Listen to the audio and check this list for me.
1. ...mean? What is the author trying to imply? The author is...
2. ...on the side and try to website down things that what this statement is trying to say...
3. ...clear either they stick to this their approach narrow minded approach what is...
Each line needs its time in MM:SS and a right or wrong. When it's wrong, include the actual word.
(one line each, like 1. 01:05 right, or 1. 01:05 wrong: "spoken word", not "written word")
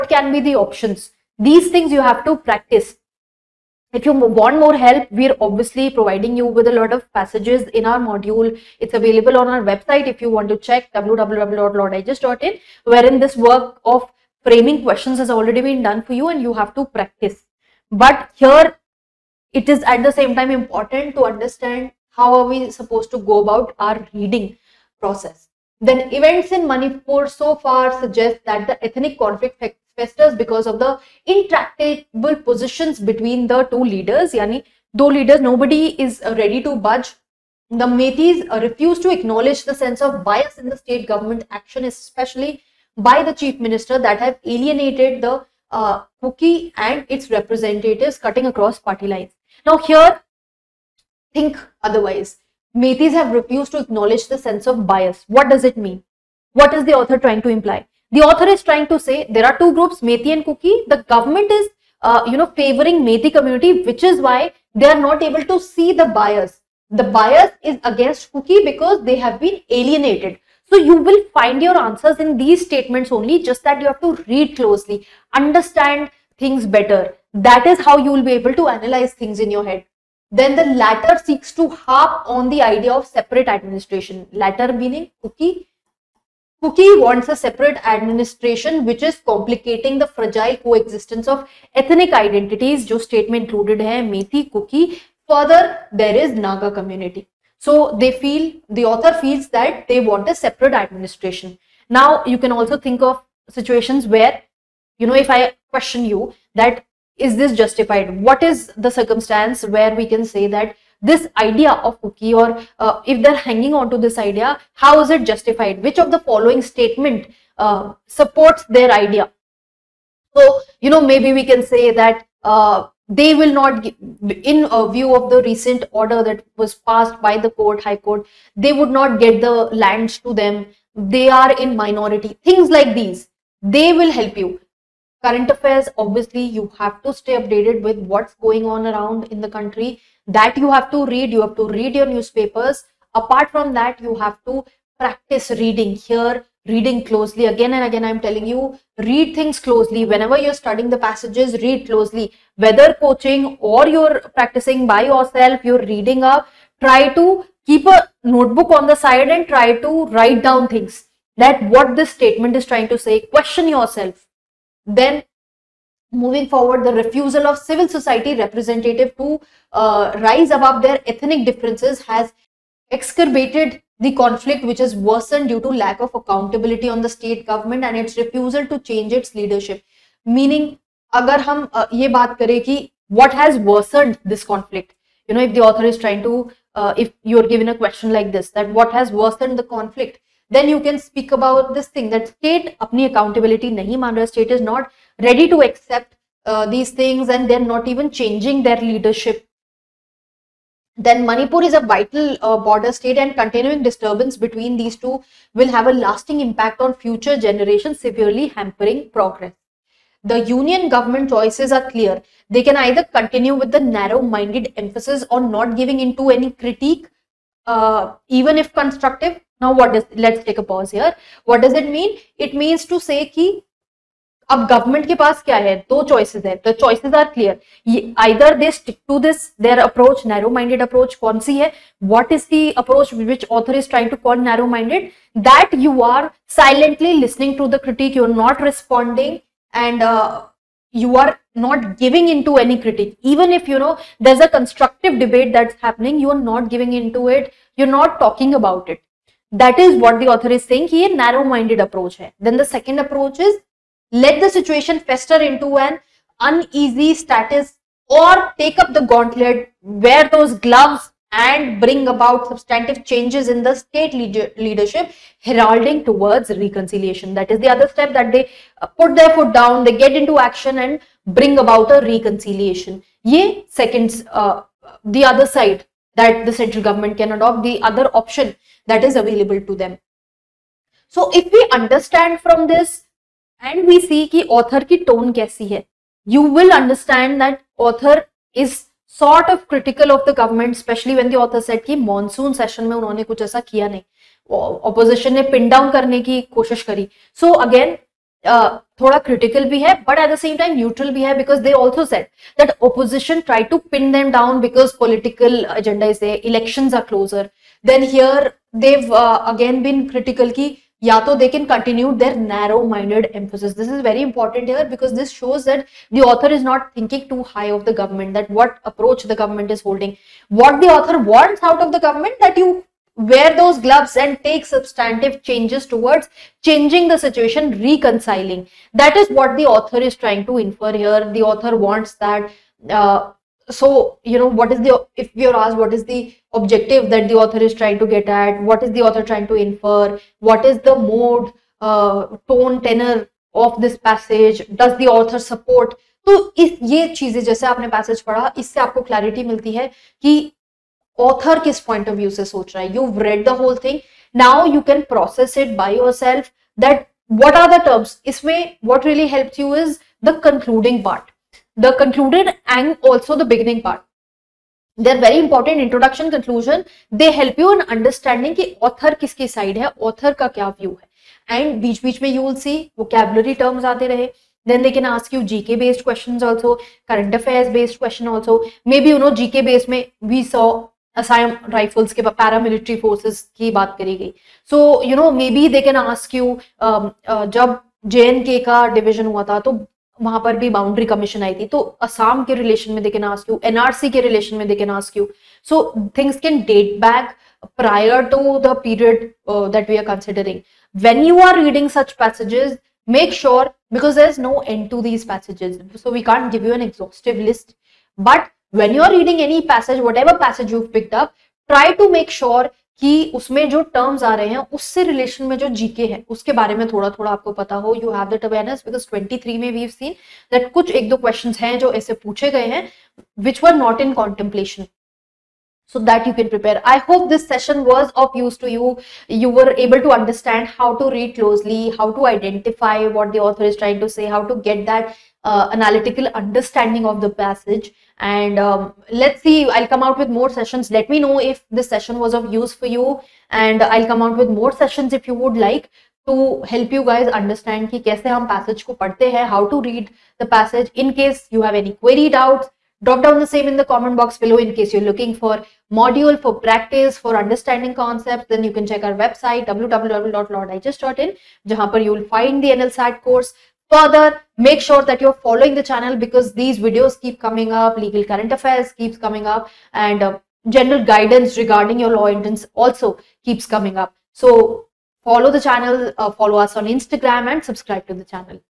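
1. 00:55 right
2. 02:38 wrong: "write", not "website"
3. 03:47 right.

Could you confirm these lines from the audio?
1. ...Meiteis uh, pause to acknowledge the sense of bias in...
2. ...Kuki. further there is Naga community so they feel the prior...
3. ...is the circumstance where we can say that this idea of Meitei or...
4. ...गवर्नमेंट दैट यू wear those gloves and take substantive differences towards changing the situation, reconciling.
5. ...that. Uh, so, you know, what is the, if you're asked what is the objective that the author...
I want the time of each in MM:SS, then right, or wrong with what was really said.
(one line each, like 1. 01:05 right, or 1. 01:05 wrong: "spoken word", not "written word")
1. 00:37 wrong: "refuse", not "pause"
2. 01:34 wrong: "author", not "prior"
3. 01:48 wrong: "Kuki", not "Meitei"
4. 05:22 wrong: "changes", not "differences"
5. 05:32 right.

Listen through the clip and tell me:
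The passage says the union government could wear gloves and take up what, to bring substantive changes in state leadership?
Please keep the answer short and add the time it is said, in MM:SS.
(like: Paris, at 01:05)
The gauntlet, at 04:18.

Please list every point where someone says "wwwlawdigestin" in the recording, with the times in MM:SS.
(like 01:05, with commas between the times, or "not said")
00:10, 07:39.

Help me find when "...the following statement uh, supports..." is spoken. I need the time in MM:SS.
01:56.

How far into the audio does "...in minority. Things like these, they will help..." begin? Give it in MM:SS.
02:11.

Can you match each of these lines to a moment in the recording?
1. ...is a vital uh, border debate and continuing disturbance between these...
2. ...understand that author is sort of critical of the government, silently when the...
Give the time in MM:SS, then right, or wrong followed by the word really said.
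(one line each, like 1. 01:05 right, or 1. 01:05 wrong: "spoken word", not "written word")
1. 03:21 wrong: "state", not "debate"
2. 04:46 wrong: "especially", not "silently".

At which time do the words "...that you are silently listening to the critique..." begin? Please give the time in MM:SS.
03:55.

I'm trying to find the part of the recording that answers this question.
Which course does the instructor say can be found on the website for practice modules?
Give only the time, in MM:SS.
07:42.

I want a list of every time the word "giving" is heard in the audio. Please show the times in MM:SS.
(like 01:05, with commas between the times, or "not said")
03:35, 04:01, 04:06.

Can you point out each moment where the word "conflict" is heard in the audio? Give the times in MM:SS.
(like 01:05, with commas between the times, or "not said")
00:29, 02:54, 03:04, 03:09.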